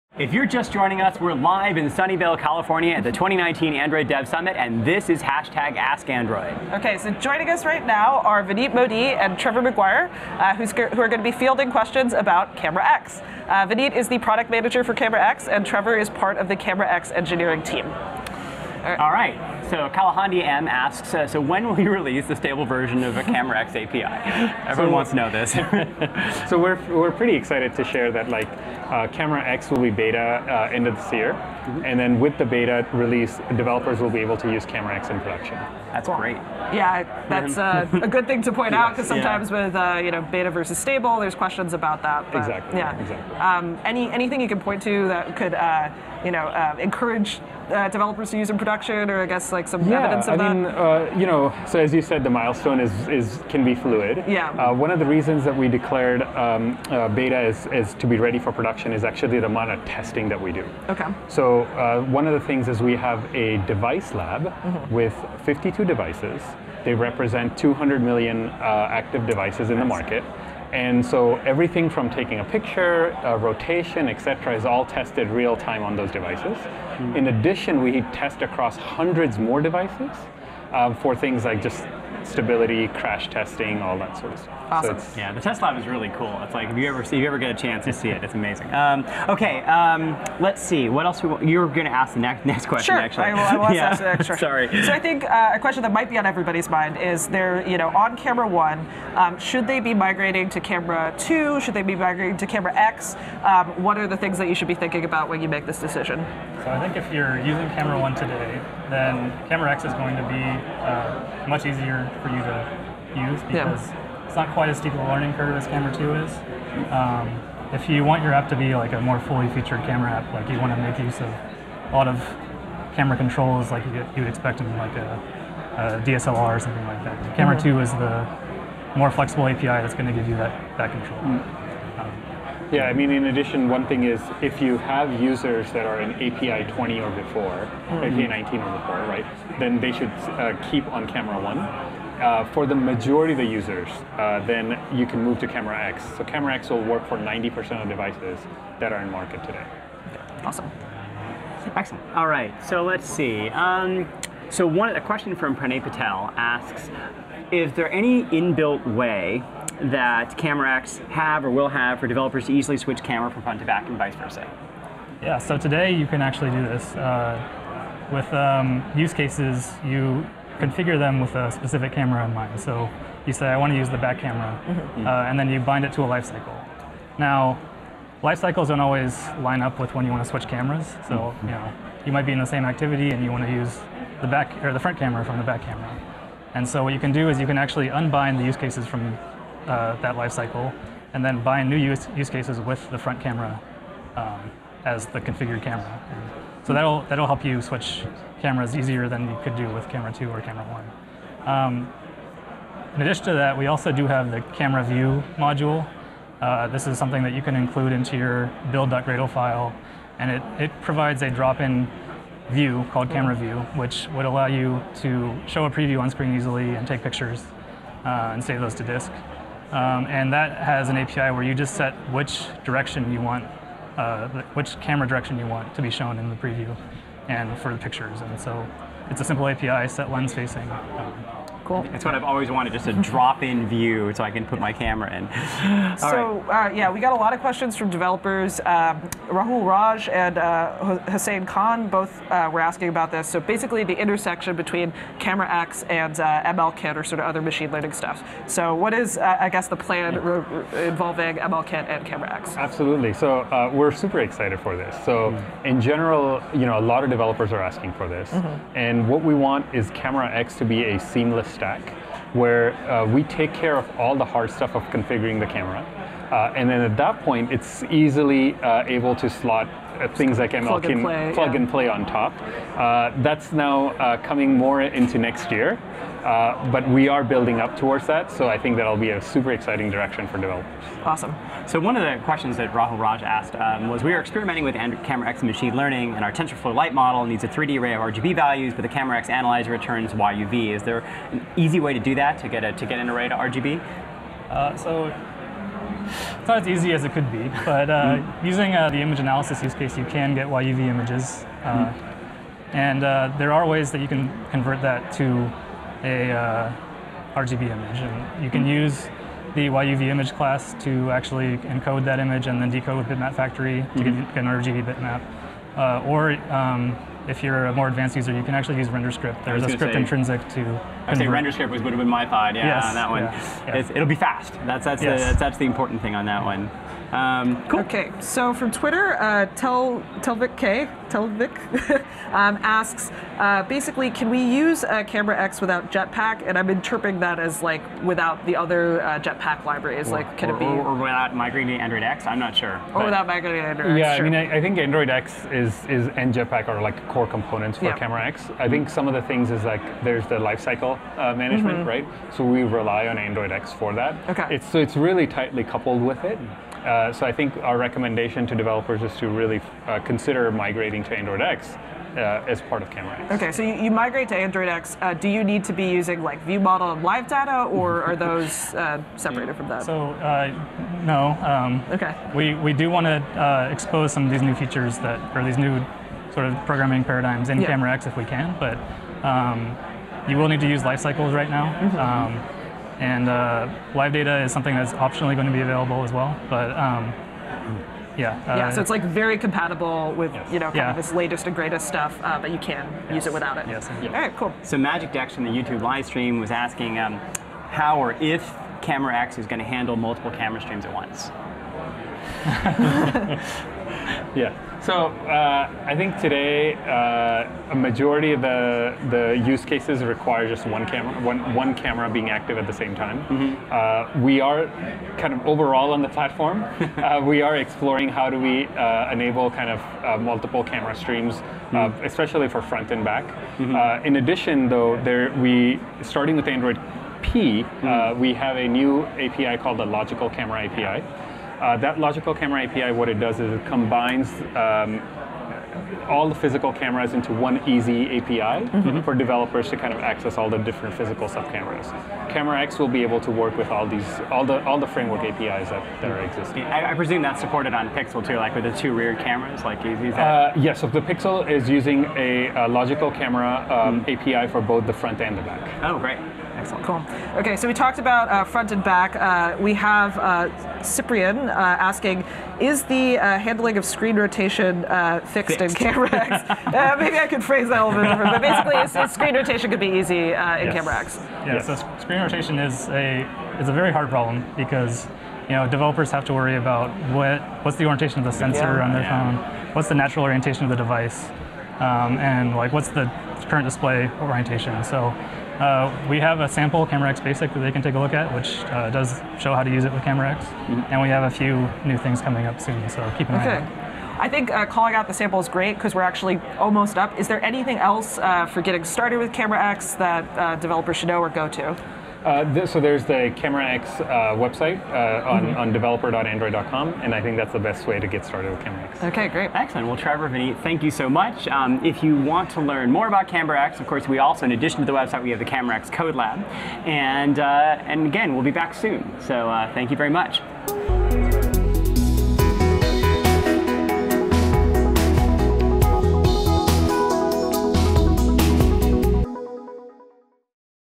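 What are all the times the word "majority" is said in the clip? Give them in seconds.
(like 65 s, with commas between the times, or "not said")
142 s, 407 s.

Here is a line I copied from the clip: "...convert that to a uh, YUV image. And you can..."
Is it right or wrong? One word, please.
wrong.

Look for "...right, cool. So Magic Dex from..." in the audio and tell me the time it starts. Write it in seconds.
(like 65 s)
394 s.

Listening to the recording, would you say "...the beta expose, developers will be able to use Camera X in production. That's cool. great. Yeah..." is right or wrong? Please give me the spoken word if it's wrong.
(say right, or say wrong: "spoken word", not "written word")
wrong: "release", not "expose".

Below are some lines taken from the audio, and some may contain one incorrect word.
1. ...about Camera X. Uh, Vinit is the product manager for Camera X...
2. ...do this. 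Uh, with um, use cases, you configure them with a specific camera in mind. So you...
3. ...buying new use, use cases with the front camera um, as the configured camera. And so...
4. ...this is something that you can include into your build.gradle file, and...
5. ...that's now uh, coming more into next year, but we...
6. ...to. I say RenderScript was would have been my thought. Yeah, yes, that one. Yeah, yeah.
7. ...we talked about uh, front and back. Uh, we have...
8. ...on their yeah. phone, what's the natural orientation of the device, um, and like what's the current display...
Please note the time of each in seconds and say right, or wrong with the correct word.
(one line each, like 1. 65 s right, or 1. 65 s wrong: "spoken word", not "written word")
1. 12 s right
2. 166 s right
3. 191 s right
4. 206 s right
5. 273 s right
6. 320 s right
7. 457 s right
8. 478 s right.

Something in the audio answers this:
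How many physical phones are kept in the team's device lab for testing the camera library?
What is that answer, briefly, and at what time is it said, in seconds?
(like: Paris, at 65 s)
52, at 65 s.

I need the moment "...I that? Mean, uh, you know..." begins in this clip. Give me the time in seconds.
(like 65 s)
50 s.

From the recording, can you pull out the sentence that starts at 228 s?
And so it's a simple API, set lens facing.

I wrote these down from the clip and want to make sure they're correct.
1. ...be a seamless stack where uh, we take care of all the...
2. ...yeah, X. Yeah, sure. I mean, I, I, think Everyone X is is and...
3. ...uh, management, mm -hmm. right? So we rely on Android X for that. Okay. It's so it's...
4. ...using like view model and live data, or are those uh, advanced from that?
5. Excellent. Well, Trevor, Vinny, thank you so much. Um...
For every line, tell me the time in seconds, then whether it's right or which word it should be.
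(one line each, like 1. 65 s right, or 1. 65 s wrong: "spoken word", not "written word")
1. 260 s right
2. 343 s wrong: "Android", not "Everyone"
3. 351 s right
4. 365 s wrong: "separated", not "advanced"
5. 509 s right.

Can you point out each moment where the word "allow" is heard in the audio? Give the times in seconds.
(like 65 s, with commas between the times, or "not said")
214 s.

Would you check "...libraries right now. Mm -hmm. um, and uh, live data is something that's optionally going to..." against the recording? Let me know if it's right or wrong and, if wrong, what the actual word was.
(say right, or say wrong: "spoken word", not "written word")
wrong: "cycles", not "libraries".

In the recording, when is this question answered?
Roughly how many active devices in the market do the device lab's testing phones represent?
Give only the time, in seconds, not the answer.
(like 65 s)
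67 s.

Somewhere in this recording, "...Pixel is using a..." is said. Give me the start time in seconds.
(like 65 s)
451 s.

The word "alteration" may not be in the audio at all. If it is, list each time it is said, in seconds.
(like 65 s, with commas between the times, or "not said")
not said.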